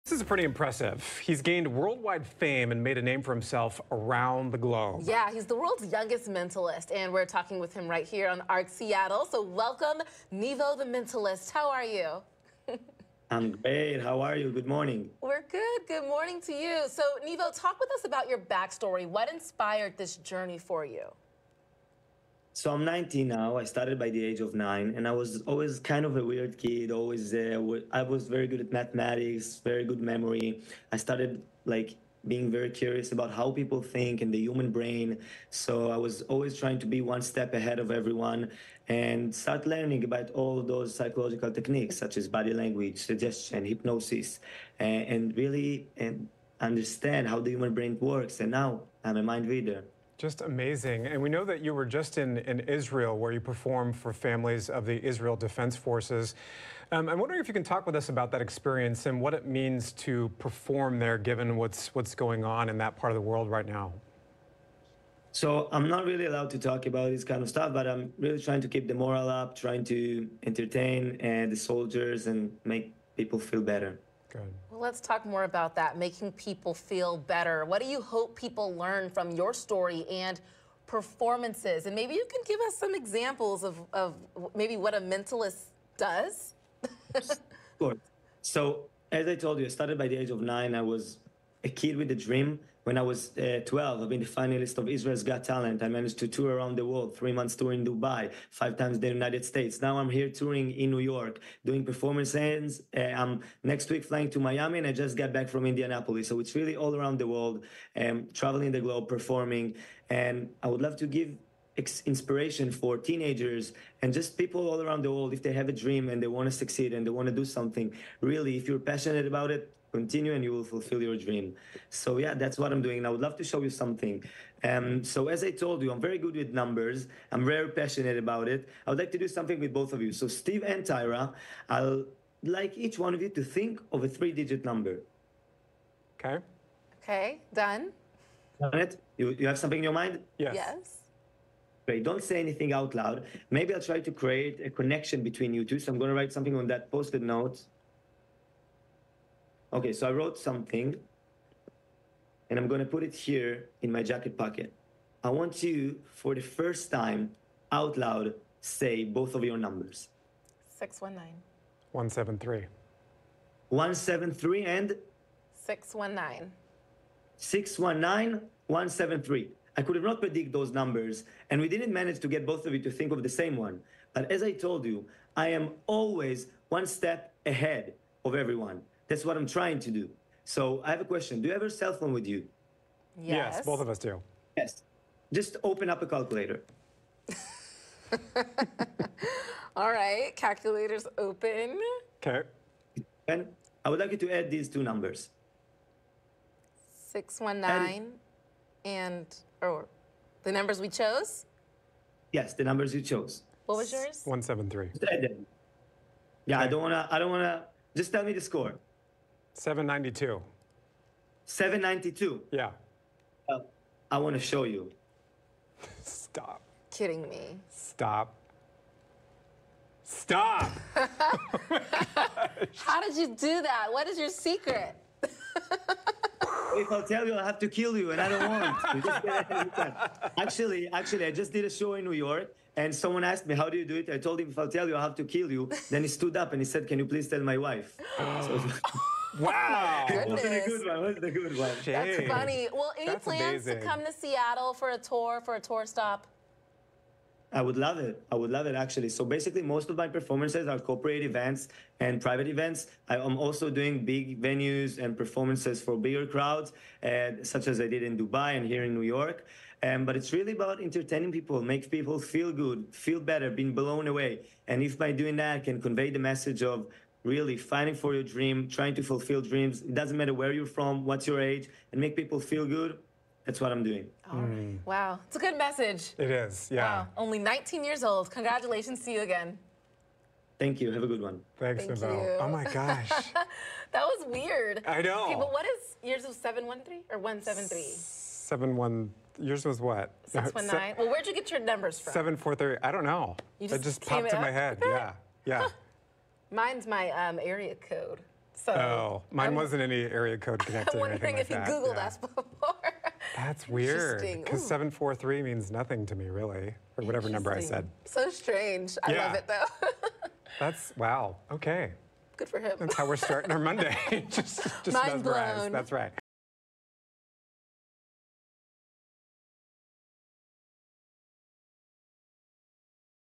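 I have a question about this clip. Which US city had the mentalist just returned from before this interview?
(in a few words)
Indianapolis.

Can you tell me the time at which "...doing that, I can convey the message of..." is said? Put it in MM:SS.
04:25.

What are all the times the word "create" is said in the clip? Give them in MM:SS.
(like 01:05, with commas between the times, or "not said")
02:24.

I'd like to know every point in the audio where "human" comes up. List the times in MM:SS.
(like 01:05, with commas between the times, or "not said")
00:34, 00:47.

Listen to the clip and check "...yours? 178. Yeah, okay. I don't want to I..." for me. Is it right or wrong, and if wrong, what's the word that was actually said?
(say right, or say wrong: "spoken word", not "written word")
wrong: "173", not "178".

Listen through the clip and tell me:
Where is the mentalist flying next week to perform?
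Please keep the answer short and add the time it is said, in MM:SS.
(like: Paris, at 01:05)
Miami, at 01:44.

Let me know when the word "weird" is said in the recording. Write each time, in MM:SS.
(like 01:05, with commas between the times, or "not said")
00:26, 04:44, 05:03.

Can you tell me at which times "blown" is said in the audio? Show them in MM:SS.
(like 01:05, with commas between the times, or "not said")
04:23, 05:15.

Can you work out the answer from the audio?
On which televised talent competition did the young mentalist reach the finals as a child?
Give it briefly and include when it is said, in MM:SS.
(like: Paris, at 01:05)
Israel's Got Talent, at 01:34.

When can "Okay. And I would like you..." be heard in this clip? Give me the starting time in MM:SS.
03:12.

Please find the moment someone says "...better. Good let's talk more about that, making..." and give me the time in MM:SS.
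01:13.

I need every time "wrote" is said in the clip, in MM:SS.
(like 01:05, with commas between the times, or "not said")
02:30.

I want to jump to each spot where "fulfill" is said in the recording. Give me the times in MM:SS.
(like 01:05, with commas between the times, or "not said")
02:00, 04:29.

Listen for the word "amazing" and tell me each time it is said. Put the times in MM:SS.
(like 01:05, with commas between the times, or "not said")
00:50, 04:03.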